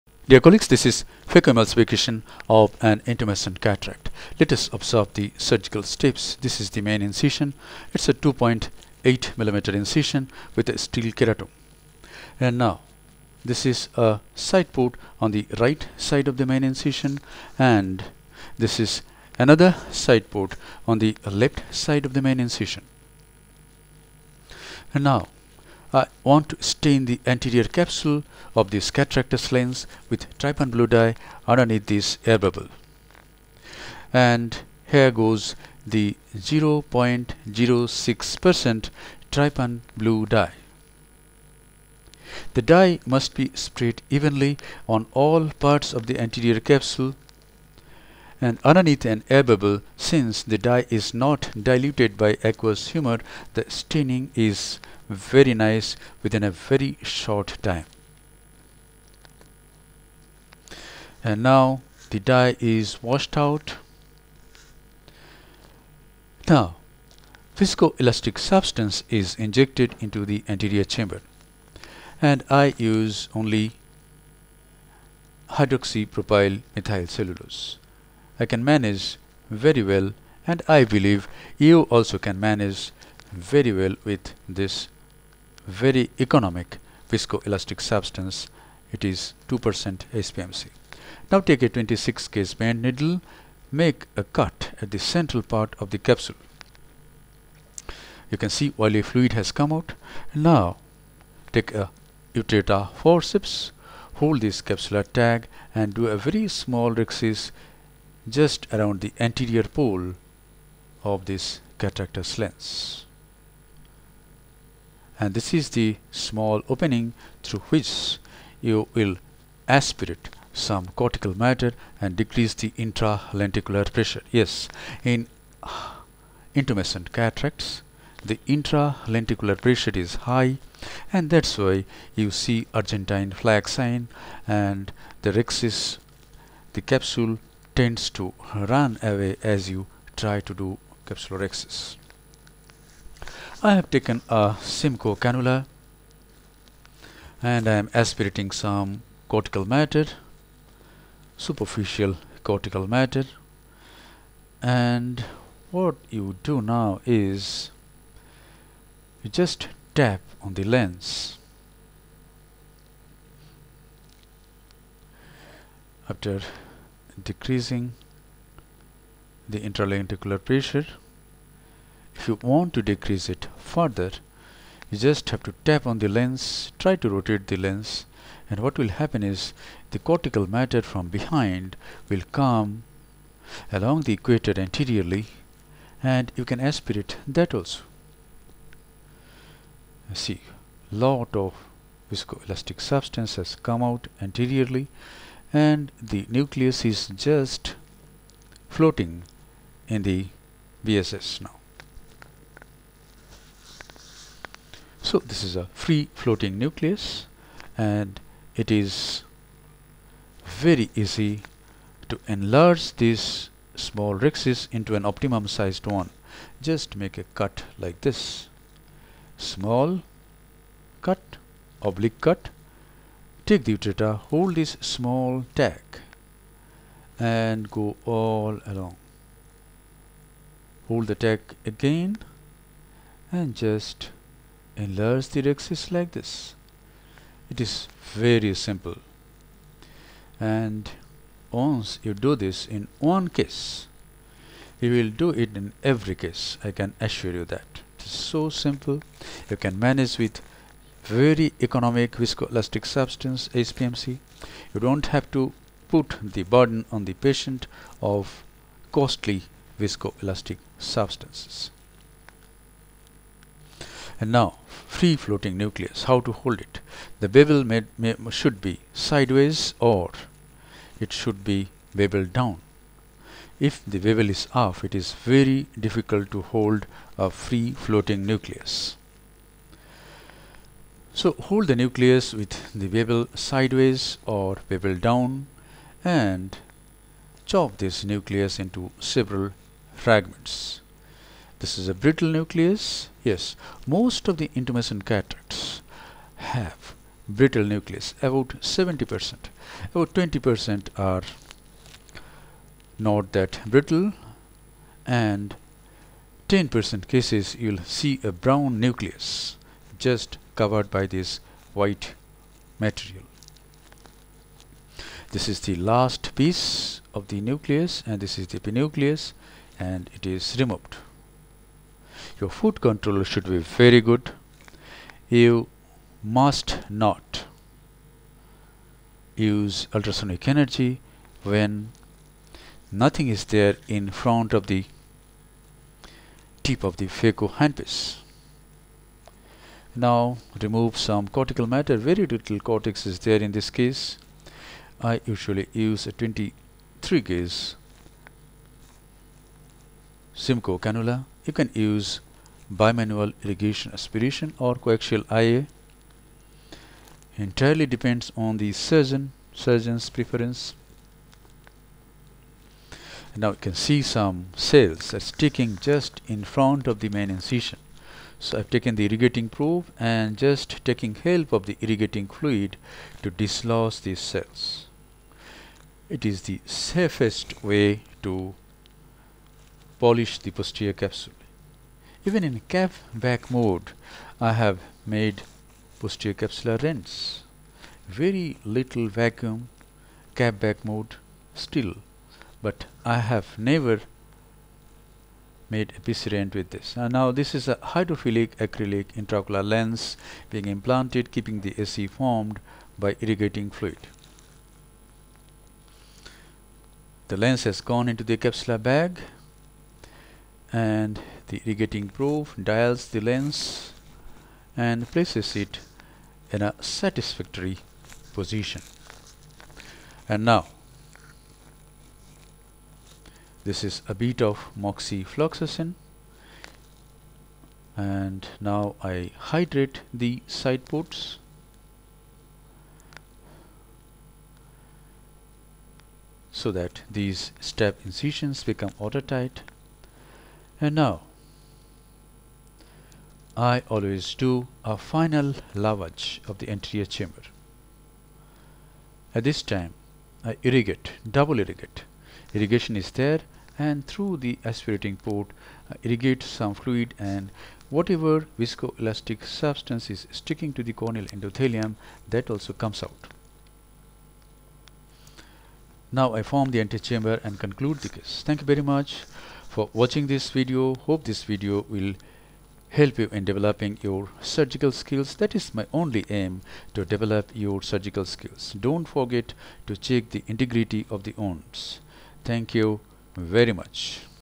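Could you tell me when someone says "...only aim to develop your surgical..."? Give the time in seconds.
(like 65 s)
475 s.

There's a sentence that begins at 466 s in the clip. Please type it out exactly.
Now I form the antechamber and conclude the case.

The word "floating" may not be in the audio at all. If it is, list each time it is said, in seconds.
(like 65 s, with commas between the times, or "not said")
198 s, 206 s, 265 s, 277 s.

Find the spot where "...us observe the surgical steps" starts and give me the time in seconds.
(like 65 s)
4 s.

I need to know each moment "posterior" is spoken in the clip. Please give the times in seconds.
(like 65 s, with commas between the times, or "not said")
380 s, 385 s.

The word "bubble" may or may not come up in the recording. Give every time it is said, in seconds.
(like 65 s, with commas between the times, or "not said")
32 s, 49 s.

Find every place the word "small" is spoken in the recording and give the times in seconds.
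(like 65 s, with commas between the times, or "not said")
106 s, 116 s, 213 s, 219 s, 224 s.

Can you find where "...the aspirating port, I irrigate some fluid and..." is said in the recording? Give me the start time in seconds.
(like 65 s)
454 s.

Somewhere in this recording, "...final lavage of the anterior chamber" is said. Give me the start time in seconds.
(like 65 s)
444 s.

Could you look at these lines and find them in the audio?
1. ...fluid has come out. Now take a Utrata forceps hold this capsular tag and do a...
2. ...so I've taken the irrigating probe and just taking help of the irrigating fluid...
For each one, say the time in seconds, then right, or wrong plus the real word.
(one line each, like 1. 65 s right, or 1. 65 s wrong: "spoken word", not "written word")
1. 99 s right
2. 368 s right.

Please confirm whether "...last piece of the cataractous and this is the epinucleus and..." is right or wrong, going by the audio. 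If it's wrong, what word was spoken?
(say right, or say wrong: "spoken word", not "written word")
wrong: "nucleus", not "cataractous".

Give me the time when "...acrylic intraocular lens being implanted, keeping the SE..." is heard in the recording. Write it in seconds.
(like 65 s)
398 s.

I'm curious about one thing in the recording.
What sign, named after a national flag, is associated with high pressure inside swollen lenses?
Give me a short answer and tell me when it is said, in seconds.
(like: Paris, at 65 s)
Argentine flag sign, at 132 s.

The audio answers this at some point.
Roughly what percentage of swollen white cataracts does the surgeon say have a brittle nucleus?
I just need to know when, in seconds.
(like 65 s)
298 s.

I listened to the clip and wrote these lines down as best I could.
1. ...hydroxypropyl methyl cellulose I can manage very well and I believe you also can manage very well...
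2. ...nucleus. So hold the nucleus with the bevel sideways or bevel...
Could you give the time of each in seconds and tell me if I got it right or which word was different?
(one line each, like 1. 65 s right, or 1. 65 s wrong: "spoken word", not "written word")
1. 75 s right
2. 278 s right.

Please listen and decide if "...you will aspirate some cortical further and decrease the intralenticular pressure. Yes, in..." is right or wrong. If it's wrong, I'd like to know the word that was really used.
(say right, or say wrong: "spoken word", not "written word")
wrong: "matter", not "further".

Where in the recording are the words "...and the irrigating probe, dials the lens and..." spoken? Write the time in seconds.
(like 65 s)
410 s.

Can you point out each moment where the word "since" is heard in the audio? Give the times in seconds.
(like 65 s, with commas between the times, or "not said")
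49 s.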